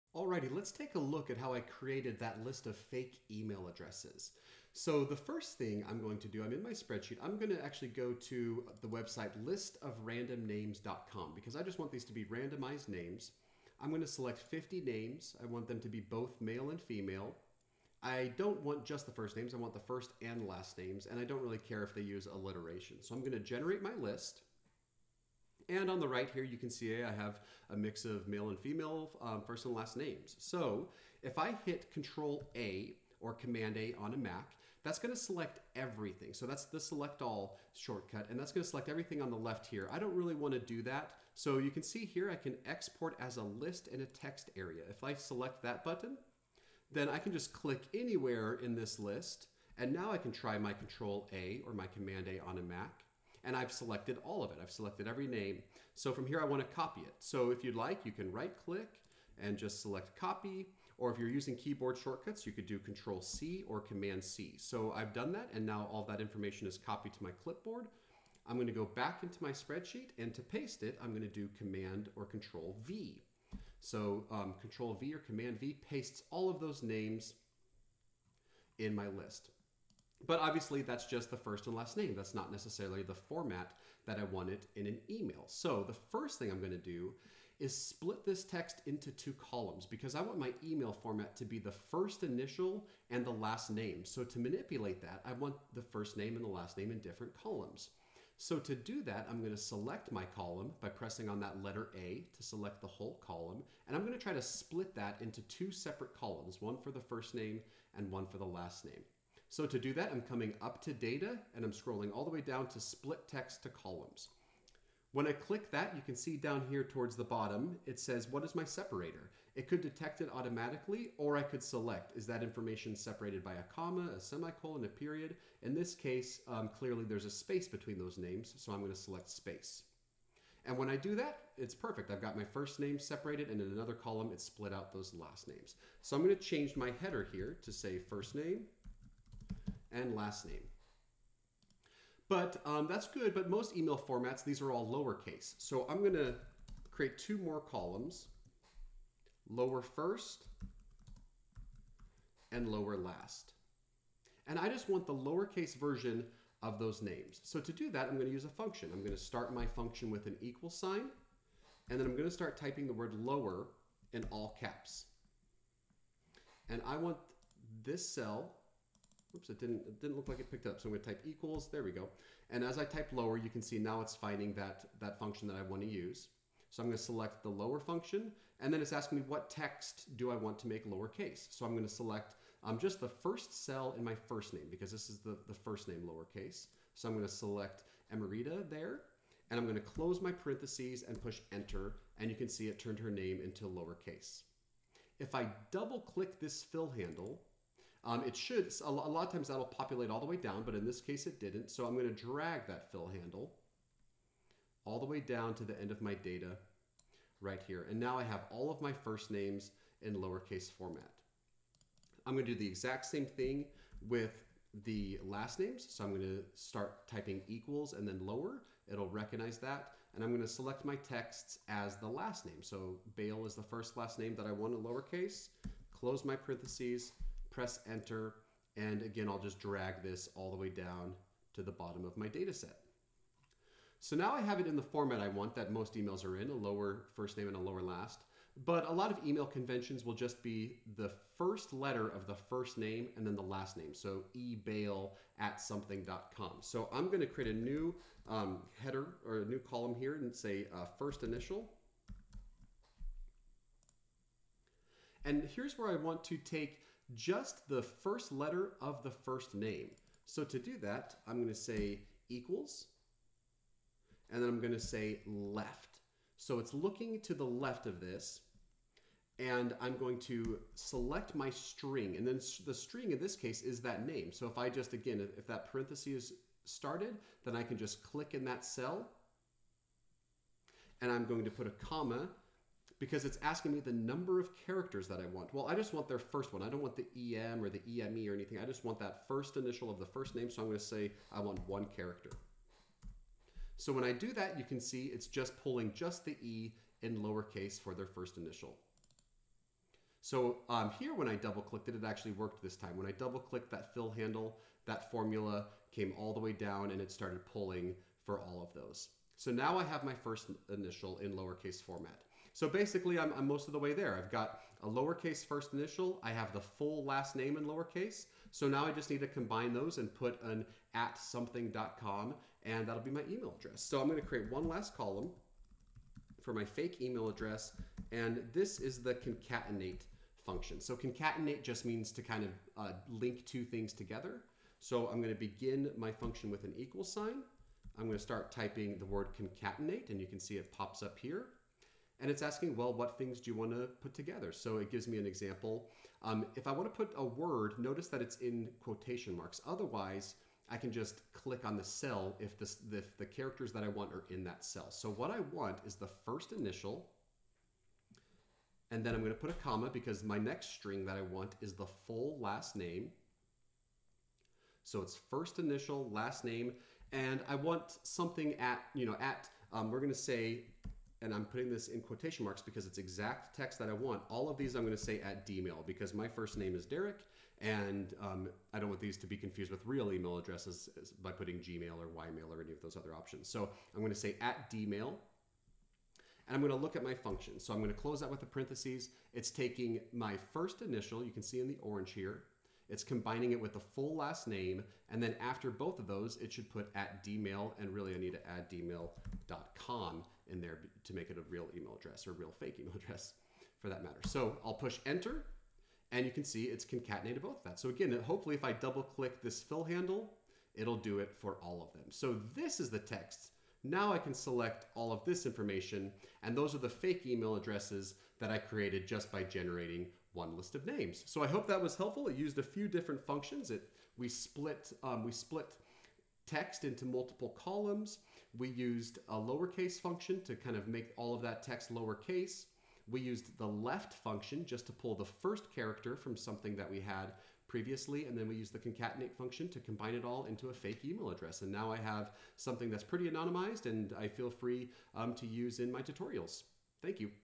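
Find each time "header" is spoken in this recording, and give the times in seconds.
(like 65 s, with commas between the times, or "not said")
137 s, 248 s.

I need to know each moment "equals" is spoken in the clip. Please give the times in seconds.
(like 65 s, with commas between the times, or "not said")
160 s, 171 s, 217 s, 262 s, 336 s.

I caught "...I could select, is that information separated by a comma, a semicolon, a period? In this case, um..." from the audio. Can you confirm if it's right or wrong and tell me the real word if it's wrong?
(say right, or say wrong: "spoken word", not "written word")
right.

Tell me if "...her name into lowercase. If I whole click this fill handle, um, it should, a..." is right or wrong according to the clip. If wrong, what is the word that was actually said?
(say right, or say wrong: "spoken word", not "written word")
wrong: "double", not "whole".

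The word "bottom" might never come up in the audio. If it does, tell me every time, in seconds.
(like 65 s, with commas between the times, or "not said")
117 s, 231 s.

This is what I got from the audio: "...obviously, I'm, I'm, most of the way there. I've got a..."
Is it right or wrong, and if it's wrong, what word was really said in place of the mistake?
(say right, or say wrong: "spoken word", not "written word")
wrong: "basically", not "obviously".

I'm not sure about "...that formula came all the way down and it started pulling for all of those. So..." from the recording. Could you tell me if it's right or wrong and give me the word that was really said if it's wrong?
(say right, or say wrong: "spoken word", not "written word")
right.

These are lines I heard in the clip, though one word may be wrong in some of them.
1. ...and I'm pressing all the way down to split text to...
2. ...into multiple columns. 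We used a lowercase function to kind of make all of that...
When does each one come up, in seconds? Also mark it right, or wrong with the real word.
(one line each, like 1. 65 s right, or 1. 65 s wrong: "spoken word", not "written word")
1. 111 s wrong: "scrolling", not "pressing"
2. 426 s right.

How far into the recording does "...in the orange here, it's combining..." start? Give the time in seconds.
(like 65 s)
391 s.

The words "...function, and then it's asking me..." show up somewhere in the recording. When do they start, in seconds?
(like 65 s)
177 s.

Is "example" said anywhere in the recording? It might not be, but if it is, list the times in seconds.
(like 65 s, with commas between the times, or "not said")
345 s.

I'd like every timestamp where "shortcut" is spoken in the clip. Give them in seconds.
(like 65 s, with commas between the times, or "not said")
37 s, 61 s.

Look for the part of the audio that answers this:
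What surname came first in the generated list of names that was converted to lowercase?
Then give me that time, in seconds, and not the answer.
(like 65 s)
223 s.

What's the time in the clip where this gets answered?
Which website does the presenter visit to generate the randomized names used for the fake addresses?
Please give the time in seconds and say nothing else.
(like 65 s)
9 s.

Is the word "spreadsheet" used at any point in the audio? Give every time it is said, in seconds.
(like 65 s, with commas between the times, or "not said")
6 s, 69 s.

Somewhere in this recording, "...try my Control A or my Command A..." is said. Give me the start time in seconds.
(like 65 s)
50 s.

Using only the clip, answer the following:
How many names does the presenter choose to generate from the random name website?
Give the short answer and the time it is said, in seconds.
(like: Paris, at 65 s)
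50, at 14 s.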